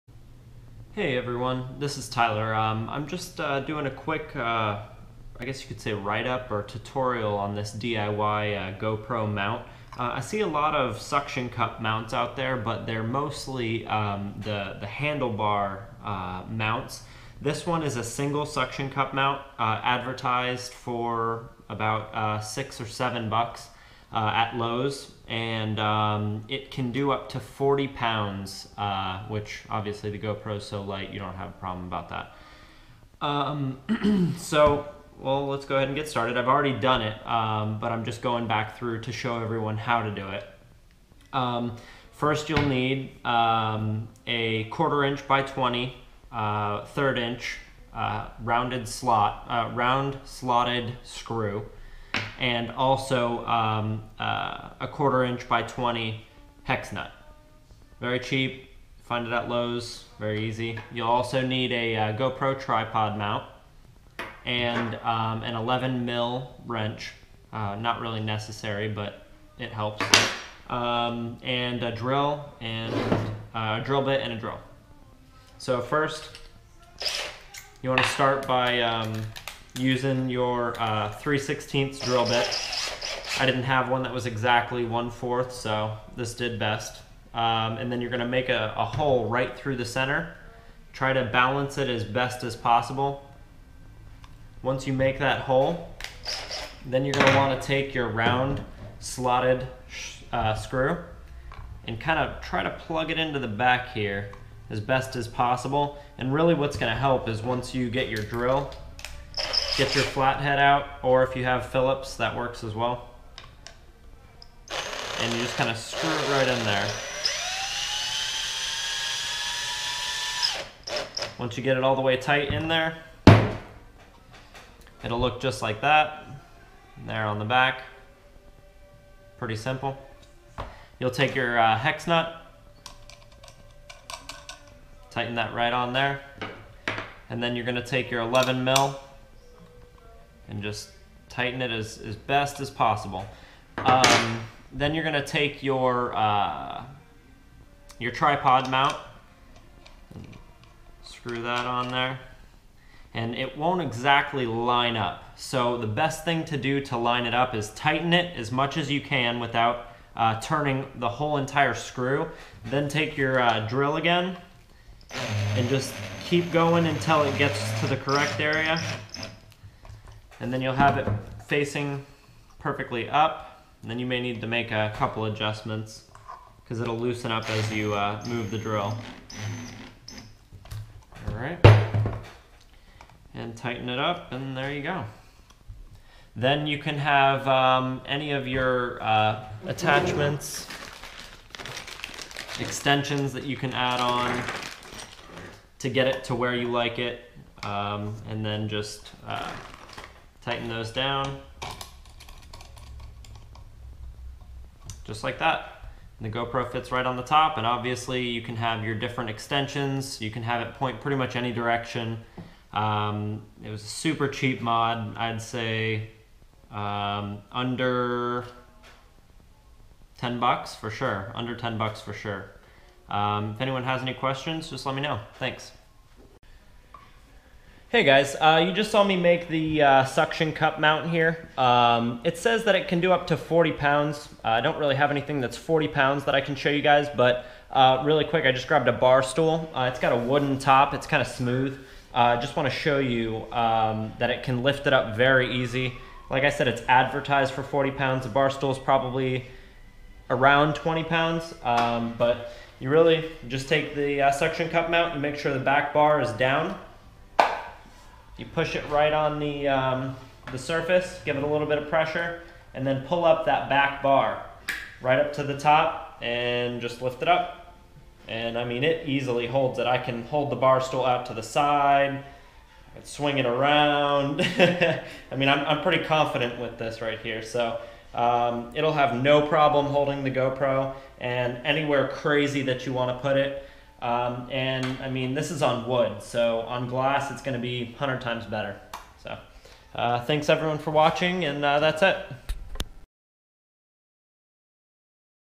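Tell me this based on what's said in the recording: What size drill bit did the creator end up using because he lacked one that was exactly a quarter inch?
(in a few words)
3/16.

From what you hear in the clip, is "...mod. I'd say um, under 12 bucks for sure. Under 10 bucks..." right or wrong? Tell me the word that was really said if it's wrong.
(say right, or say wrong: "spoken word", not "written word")
wrong: "10", not "12".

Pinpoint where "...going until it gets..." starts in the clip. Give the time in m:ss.
2:46.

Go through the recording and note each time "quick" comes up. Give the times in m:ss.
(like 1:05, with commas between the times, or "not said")
0:03, 3:58.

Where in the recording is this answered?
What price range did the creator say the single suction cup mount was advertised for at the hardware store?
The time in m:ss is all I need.
0:22.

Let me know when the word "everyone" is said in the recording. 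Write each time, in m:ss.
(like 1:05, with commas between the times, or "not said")
0:01, 0:39, 4:50.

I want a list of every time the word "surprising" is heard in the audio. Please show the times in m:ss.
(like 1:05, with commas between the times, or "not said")
not said.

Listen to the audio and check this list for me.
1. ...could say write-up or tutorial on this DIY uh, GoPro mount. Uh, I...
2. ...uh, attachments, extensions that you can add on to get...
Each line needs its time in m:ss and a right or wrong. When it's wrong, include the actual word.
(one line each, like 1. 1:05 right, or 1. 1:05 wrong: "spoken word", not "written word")
1. 0:05 right
2. 3:09 right.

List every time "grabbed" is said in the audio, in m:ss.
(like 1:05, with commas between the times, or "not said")
3:58.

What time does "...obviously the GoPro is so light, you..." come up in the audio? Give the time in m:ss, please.
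0:29.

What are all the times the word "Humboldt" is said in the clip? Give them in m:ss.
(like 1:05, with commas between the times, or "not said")
not said.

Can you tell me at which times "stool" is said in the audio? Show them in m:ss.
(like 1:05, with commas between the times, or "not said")
3:59, 4:08, 4:30.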